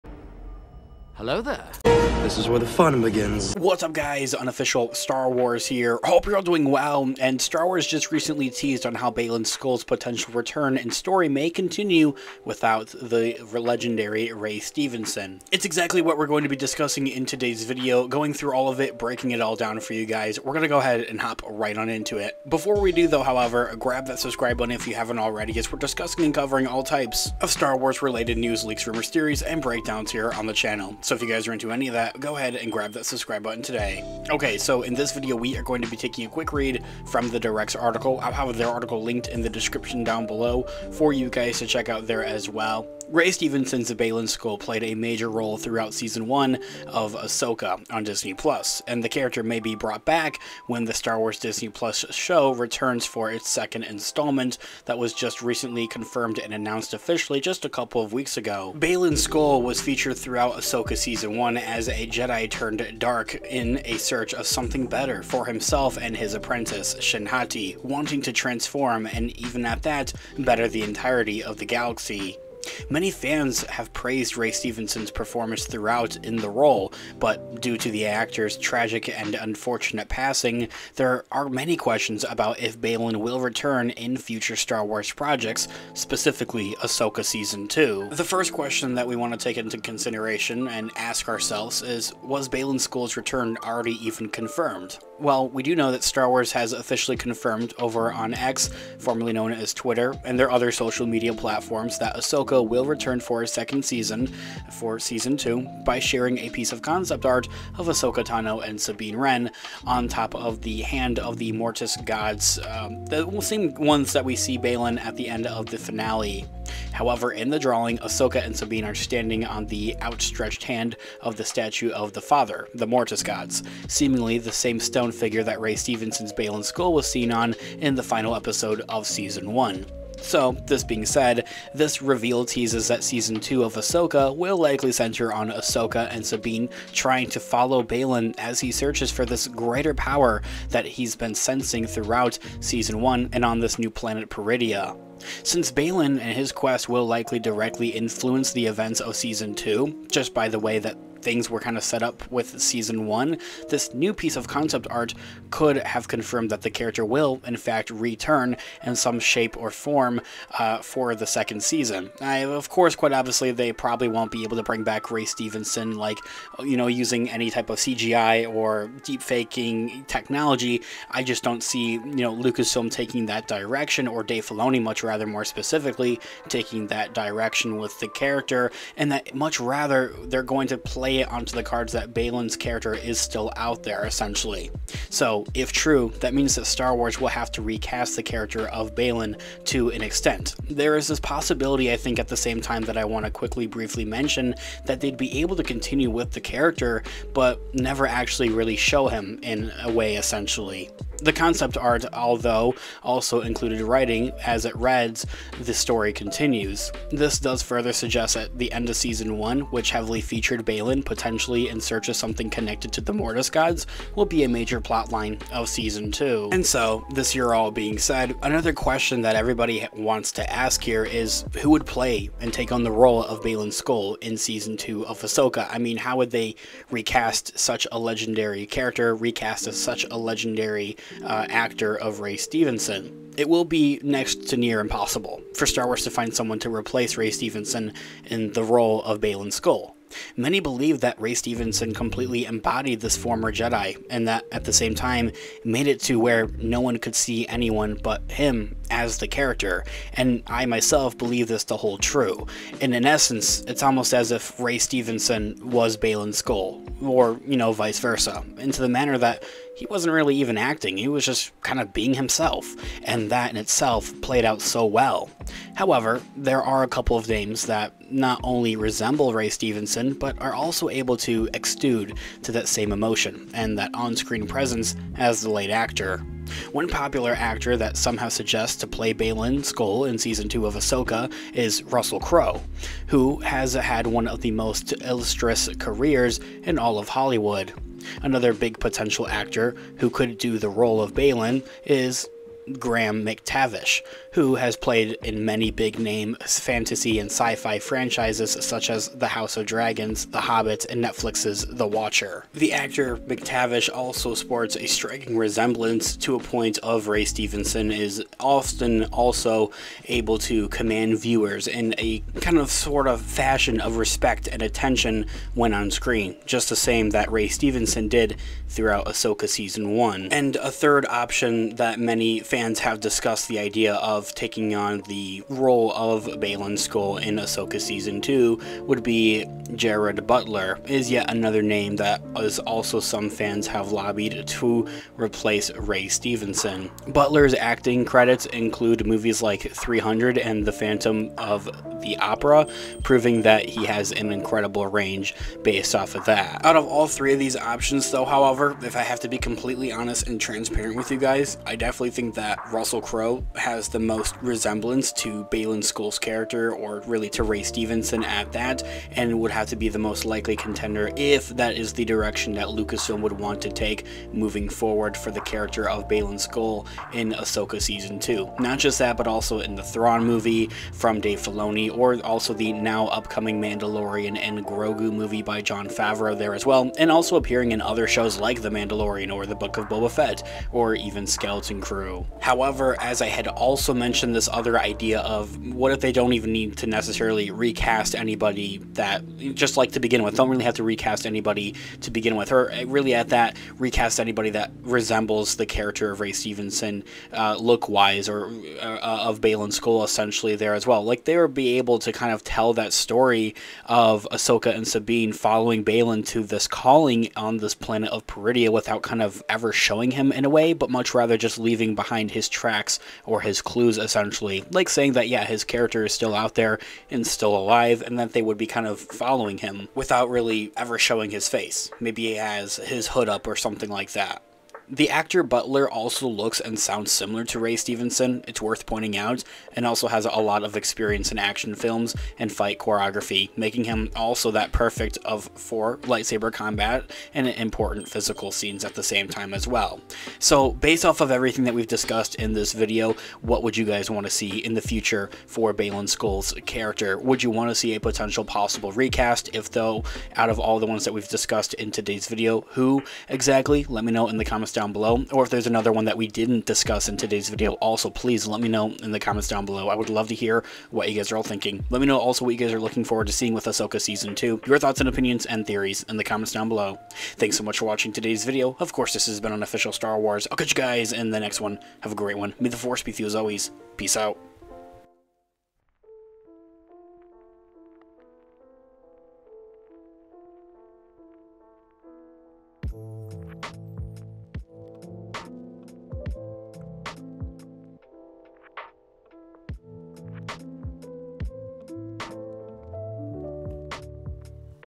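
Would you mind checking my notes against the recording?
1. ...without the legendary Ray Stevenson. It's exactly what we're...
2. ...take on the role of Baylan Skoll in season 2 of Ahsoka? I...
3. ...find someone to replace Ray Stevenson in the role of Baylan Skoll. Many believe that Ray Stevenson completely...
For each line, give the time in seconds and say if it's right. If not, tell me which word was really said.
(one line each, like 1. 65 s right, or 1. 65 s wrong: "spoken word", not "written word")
1. 12 s right
2. 222 s right
3. 236 s right.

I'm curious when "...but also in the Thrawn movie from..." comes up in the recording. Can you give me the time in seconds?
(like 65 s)
369 s.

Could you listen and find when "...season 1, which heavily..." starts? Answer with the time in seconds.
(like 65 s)
208 s.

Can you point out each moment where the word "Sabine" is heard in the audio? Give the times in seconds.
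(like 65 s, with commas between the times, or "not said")
108 s, 118 s, 136 s, 404 s.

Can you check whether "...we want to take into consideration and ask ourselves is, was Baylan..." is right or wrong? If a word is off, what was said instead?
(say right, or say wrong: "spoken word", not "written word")
right.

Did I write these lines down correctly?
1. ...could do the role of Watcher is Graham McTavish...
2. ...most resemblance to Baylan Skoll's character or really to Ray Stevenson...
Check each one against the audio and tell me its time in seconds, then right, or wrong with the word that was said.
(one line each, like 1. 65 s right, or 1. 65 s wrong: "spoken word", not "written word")
1. 290 s wrong: "Baylan", not "Watcher"
2. 353 s right.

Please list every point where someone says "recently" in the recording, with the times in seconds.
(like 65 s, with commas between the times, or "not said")
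8 s, 55 s.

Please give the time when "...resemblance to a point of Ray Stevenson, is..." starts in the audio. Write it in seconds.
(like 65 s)
305 s.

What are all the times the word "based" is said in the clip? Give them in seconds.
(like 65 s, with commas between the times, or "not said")
345 s, 440 s.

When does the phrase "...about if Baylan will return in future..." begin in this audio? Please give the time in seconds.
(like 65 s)
82 s.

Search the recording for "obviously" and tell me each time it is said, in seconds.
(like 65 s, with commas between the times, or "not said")
163 s.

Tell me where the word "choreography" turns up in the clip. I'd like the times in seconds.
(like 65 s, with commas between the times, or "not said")
432 s.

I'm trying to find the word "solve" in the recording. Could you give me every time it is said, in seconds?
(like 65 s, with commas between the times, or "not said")
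not said.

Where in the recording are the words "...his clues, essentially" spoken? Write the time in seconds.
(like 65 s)
413 s.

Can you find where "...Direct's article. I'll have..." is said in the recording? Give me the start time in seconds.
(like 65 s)
37 s.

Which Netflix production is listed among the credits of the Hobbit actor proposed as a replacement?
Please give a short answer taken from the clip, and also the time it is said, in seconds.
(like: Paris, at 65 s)
The Watcher, at 301 s.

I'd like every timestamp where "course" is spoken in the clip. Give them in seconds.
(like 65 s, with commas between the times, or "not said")
162 s, 468 s.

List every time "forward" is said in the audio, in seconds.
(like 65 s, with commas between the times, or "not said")
364 s, 463 s.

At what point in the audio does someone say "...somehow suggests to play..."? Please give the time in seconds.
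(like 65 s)
277 s.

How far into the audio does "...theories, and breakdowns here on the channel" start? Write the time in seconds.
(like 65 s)
29 s.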